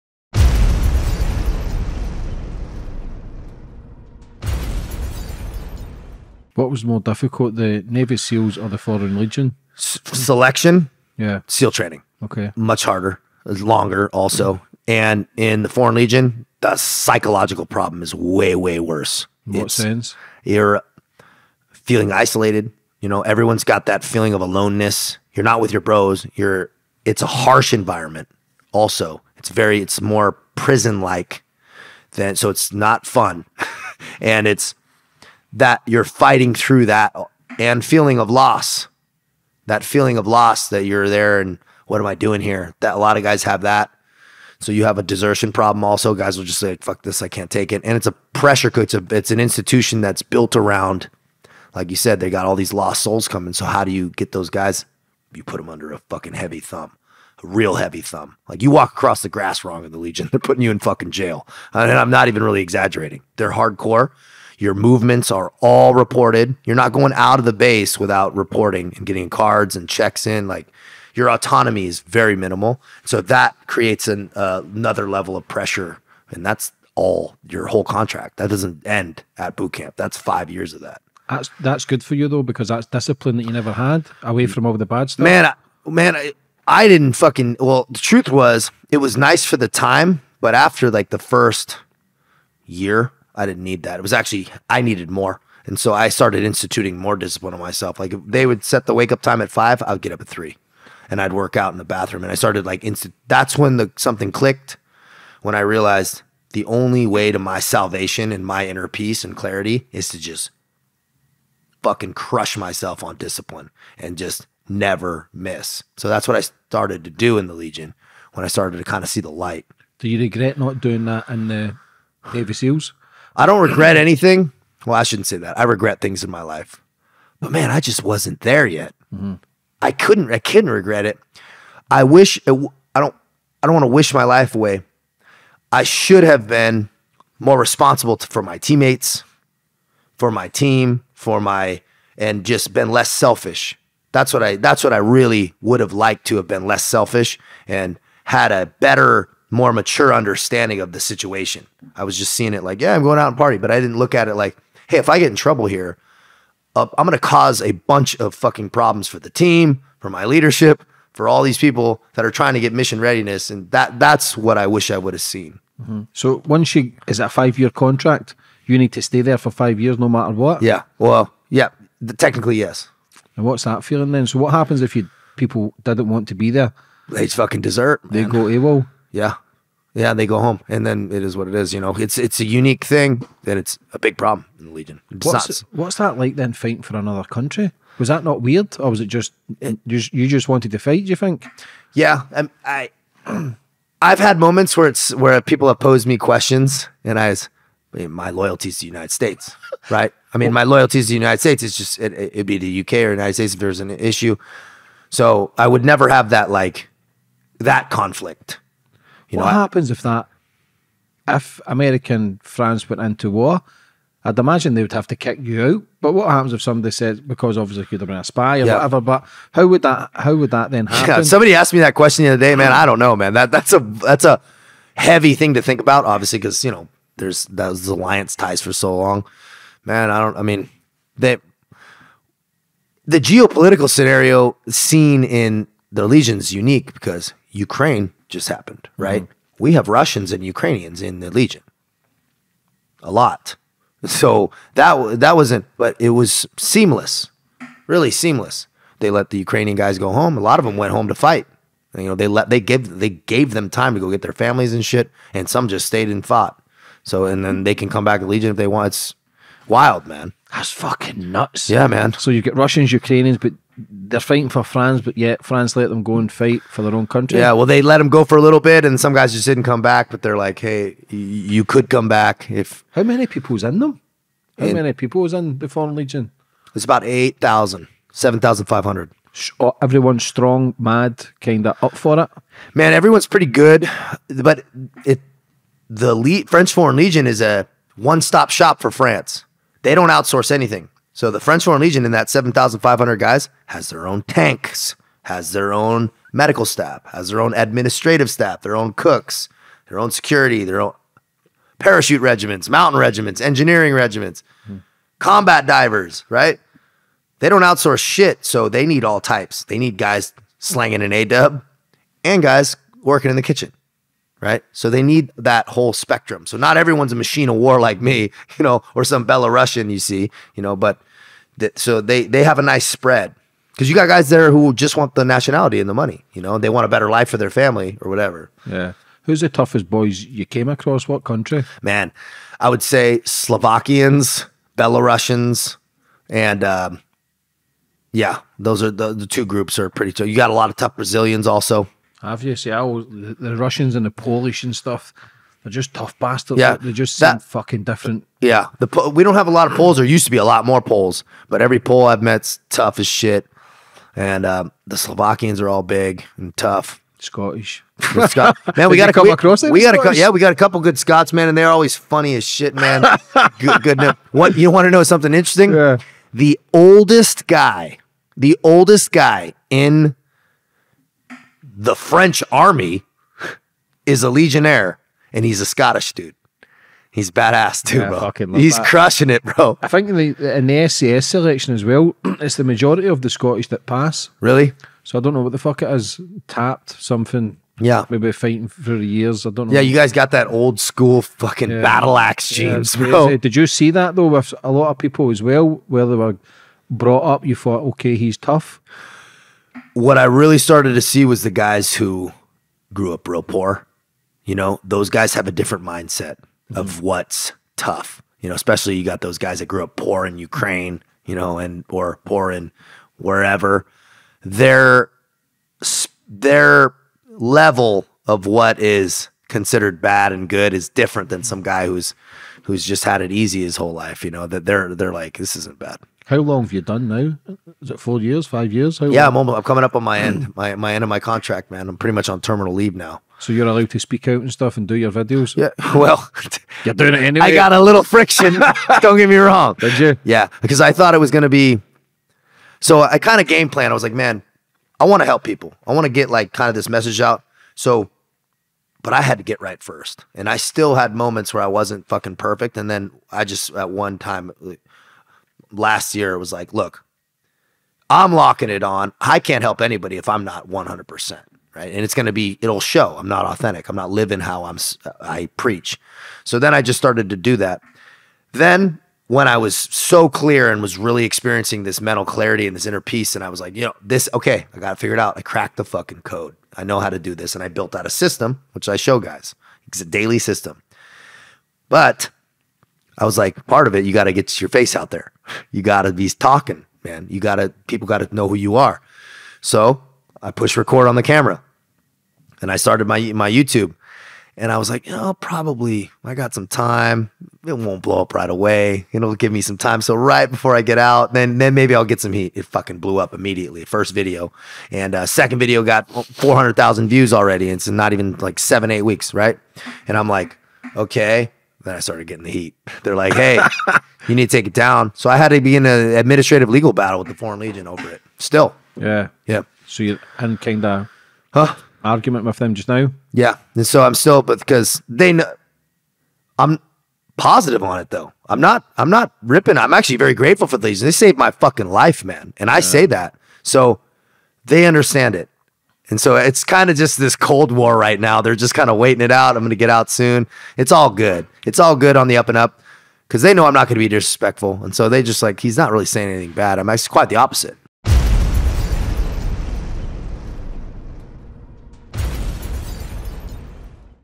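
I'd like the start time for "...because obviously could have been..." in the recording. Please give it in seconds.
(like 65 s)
217 s.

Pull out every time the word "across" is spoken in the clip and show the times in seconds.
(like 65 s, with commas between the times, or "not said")
58 s, 330 s, 359 s.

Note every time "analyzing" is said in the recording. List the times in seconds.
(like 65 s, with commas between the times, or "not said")
not said.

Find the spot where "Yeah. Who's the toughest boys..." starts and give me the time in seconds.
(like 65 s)
328 s.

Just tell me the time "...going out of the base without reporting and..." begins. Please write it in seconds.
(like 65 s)
66 s.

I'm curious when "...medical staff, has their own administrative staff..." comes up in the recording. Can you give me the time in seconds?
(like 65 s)
296 s.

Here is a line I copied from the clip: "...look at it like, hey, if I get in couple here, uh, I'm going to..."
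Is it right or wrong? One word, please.
wrong.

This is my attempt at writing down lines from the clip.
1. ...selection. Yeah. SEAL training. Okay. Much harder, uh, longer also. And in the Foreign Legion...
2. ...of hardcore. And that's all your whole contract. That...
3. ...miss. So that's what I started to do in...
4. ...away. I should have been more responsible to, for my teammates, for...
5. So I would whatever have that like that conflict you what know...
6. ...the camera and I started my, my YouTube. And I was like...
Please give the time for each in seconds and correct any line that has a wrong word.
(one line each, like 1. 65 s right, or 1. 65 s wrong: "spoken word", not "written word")
1. 10 s right
2. 75 s wrong: "pressure", not "hardcore"
3. 115 s right
4. 134 s right
5. 205 s wrong: "never", not "whatever"
6. 491 s right.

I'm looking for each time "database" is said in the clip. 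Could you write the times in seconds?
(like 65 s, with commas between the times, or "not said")
not said.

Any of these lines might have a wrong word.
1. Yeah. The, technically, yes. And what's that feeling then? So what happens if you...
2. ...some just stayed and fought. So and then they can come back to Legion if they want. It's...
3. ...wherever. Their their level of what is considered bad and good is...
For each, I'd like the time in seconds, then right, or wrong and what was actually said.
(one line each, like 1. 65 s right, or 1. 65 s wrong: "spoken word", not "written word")
1. 171 s right
2. 255 s right
3. 413 s right.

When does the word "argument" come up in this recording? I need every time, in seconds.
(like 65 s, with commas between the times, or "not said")
522 s.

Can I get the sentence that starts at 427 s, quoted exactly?
Is it four years, five years?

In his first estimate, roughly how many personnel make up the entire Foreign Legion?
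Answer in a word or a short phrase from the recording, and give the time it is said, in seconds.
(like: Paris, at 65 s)
8,000, at 277 s.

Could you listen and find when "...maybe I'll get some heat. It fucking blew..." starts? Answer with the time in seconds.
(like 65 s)
501 s.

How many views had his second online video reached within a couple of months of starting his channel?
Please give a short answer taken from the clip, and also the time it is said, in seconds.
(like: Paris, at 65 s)
400,000, at 506 s.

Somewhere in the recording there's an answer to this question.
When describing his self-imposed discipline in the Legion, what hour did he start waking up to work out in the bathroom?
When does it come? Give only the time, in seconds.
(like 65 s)
100 s.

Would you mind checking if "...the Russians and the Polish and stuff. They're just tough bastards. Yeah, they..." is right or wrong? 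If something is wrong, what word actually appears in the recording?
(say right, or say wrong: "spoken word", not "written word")
right.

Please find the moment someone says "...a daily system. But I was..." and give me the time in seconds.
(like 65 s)
480 s.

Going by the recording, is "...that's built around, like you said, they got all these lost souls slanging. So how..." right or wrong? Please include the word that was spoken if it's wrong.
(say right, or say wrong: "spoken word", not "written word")
wrong: "coming", not "slanging".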